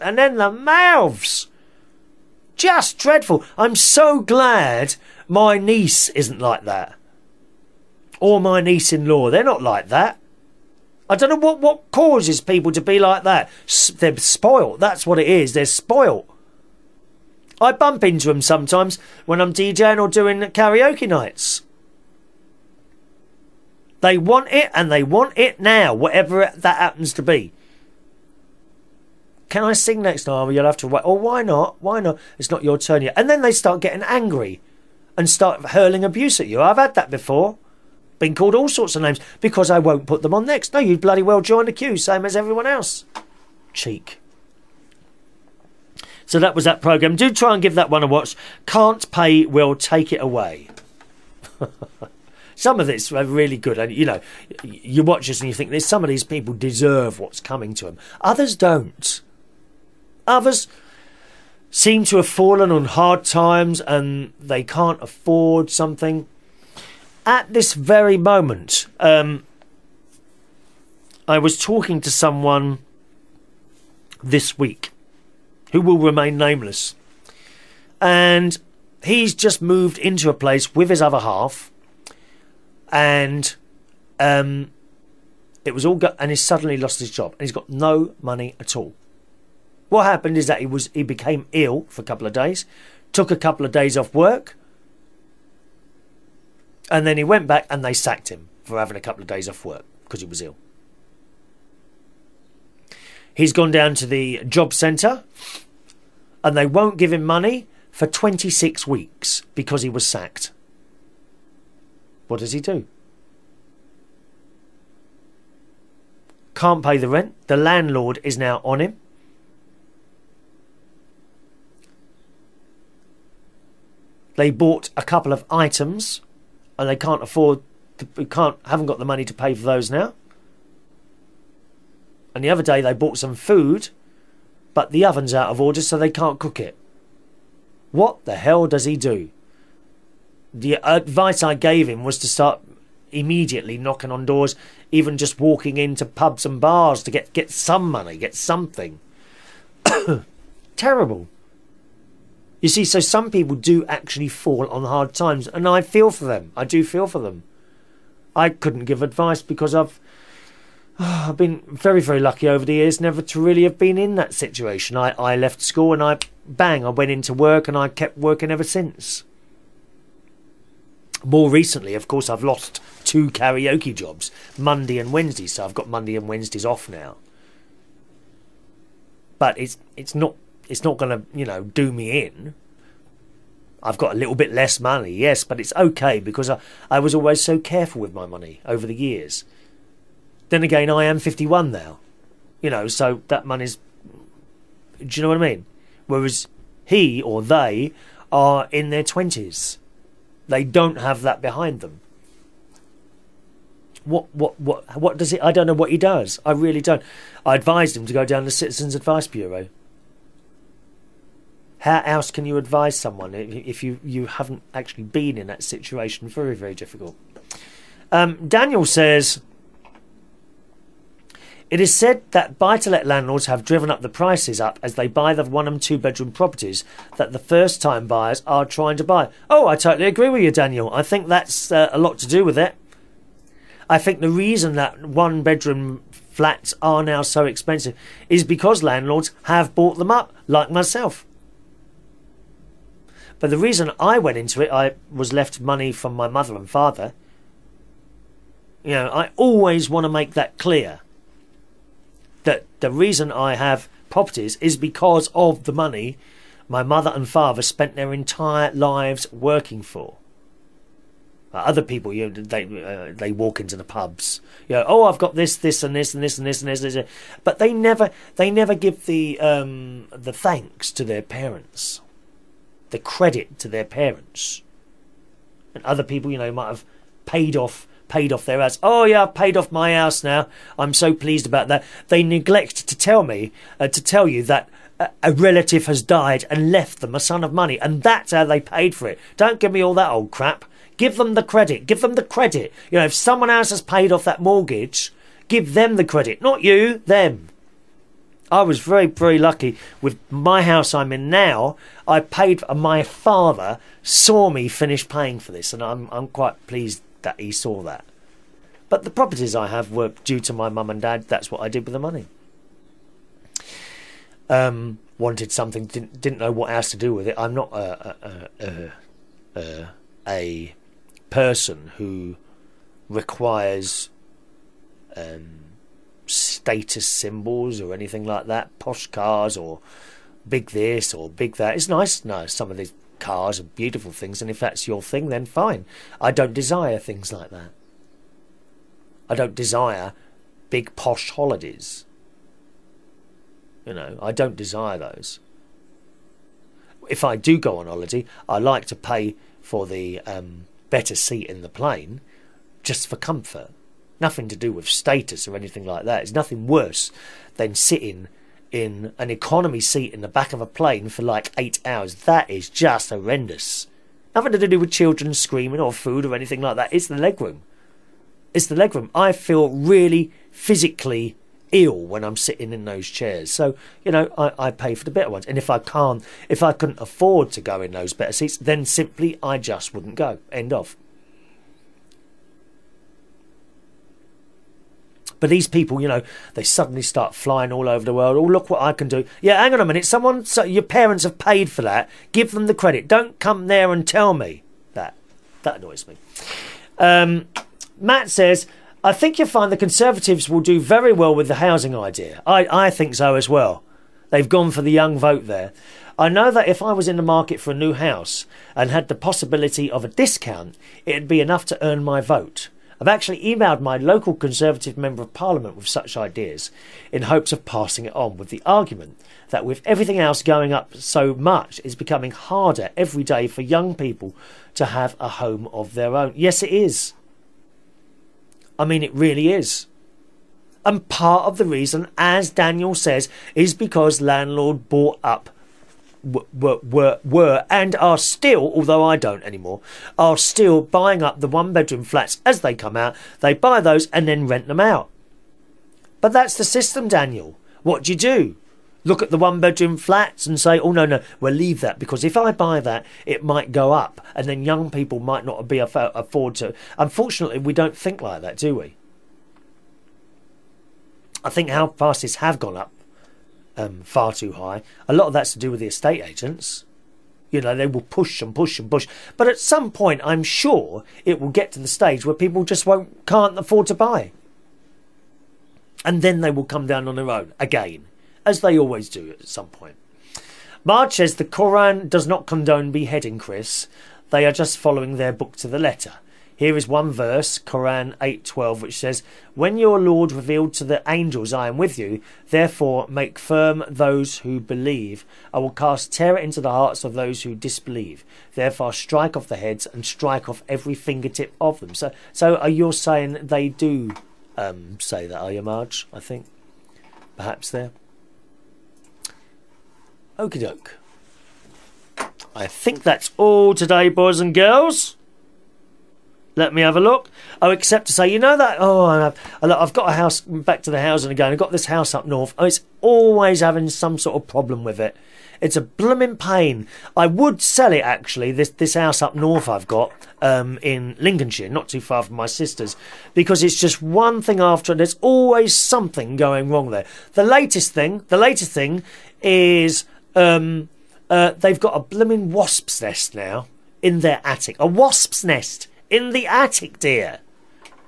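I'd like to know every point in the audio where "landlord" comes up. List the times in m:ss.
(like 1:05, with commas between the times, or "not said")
1:57, 3:43, 3:58, 7:14.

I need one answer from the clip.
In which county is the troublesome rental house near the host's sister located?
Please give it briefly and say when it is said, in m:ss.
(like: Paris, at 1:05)
Lincolnshire, at 8:51.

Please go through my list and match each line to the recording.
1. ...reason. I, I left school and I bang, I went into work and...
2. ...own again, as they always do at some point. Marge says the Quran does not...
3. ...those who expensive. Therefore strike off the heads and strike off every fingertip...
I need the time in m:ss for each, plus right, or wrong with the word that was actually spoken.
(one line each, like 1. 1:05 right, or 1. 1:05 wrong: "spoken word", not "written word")
1. 2:44 wrong: "situation", not "reason"
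2. 7:57 right
3. 8:17 wrong: "disbelieve", not "expensive".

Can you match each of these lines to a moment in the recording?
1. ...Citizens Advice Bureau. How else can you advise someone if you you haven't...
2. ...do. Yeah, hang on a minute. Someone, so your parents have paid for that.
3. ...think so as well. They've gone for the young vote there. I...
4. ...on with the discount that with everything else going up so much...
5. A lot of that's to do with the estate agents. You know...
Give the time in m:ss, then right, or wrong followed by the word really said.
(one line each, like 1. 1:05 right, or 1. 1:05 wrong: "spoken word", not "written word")
1. 3:28 right
2. 6:29 right
3. 6:42 right
4. 6:58 wrong: "argument", not "discount"
5. 7:45 right.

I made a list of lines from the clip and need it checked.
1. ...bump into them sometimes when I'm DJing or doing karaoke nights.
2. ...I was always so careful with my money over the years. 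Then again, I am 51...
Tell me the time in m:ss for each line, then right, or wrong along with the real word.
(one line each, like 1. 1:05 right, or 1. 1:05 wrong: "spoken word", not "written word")
1. 0:17 right
2. 3:06 right.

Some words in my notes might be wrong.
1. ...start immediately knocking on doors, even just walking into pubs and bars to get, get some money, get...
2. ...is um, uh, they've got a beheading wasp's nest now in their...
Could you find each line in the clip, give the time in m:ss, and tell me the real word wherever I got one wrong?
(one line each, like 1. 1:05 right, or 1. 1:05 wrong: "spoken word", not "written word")
1. 2:22 right
2. 8:59 wrong: "blooming", not "beheading".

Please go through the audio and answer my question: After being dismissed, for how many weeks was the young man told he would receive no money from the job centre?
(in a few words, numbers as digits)
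26.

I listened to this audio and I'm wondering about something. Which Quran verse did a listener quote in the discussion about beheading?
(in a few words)
8:12.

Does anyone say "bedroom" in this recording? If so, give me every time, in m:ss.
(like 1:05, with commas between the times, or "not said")
3:45, 3:55, 7:21, 7:29.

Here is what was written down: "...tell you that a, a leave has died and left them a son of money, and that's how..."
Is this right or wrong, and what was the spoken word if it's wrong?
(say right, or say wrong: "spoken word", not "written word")
wrong: "relative", not "leave".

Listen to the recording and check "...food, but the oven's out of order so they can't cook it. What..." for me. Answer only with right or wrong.
right.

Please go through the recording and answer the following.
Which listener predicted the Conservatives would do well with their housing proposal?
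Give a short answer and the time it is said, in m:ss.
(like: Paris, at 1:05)
Matt, at 6:37.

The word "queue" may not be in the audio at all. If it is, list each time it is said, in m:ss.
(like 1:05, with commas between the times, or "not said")
0:41.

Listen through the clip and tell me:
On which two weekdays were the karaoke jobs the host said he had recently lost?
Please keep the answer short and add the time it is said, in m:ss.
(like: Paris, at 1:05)
Monday and Wednesday, at 2:54.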